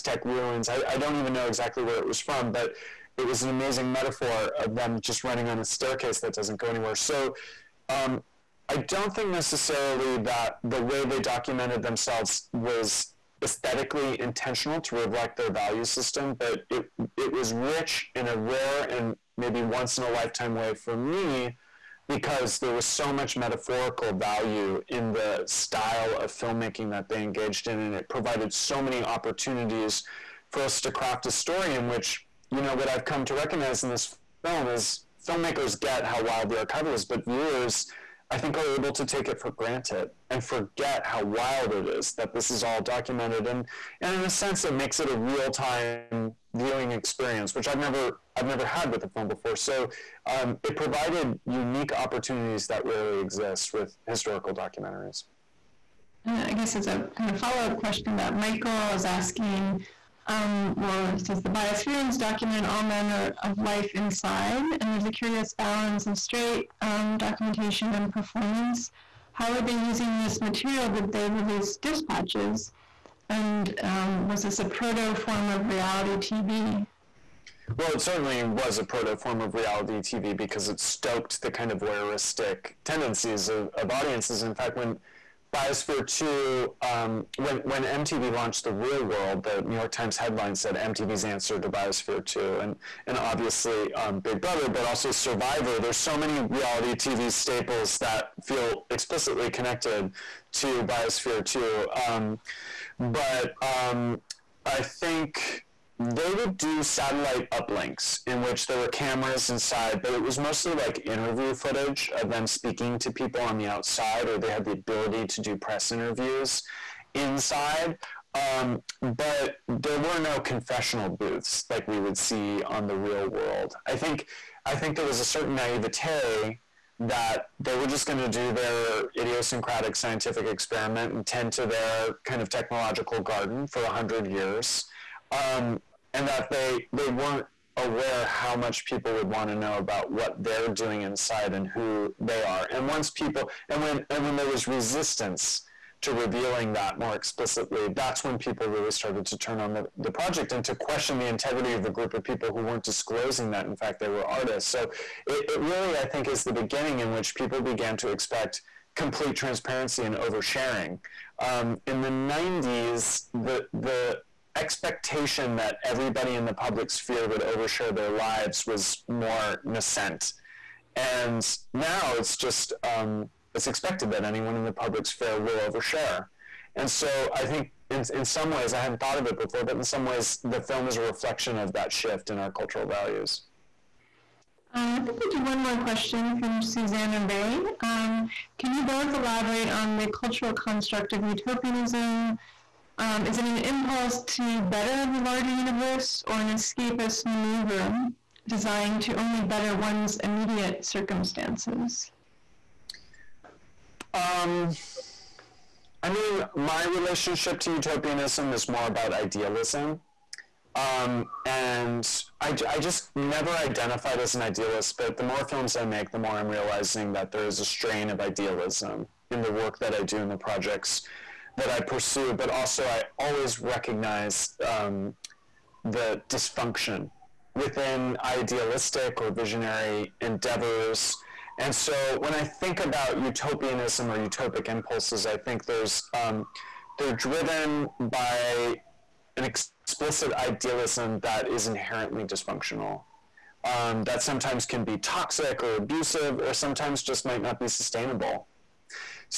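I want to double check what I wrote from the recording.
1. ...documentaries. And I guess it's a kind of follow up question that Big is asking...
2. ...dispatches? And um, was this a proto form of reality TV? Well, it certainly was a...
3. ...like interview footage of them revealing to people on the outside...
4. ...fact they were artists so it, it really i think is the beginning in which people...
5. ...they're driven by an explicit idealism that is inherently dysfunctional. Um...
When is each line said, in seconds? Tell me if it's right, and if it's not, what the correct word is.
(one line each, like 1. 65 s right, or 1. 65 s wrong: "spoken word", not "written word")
1. 54 s wrong: "Michael", not "Big"
2. 71 s right
3. 110 s wrong: "speaking", not "revealing"
4. 153 s right
5. 236 s right.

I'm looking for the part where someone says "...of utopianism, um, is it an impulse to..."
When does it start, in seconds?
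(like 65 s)
191 s.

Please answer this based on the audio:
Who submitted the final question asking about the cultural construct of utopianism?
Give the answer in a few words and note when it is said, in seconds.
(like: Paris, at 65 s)
Susanna Ray, at 186 s.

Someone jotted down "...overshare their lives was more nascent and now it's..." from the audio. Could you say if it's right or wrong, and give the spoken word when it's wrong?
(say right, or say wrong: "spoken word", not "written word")
right.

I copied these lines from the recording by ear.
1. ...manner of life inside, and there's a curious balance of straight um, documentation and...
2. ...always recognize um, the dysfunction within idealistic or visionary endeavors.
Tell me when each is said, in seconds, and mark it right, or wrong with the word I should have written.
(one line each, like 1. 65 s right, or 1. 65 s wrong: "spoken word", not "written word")
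1. 62 s right
2. 223 s right.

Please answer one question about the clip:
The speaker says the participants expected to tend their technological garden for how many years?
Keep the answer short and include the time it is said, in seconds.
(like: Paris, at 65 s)
100, at 133 s.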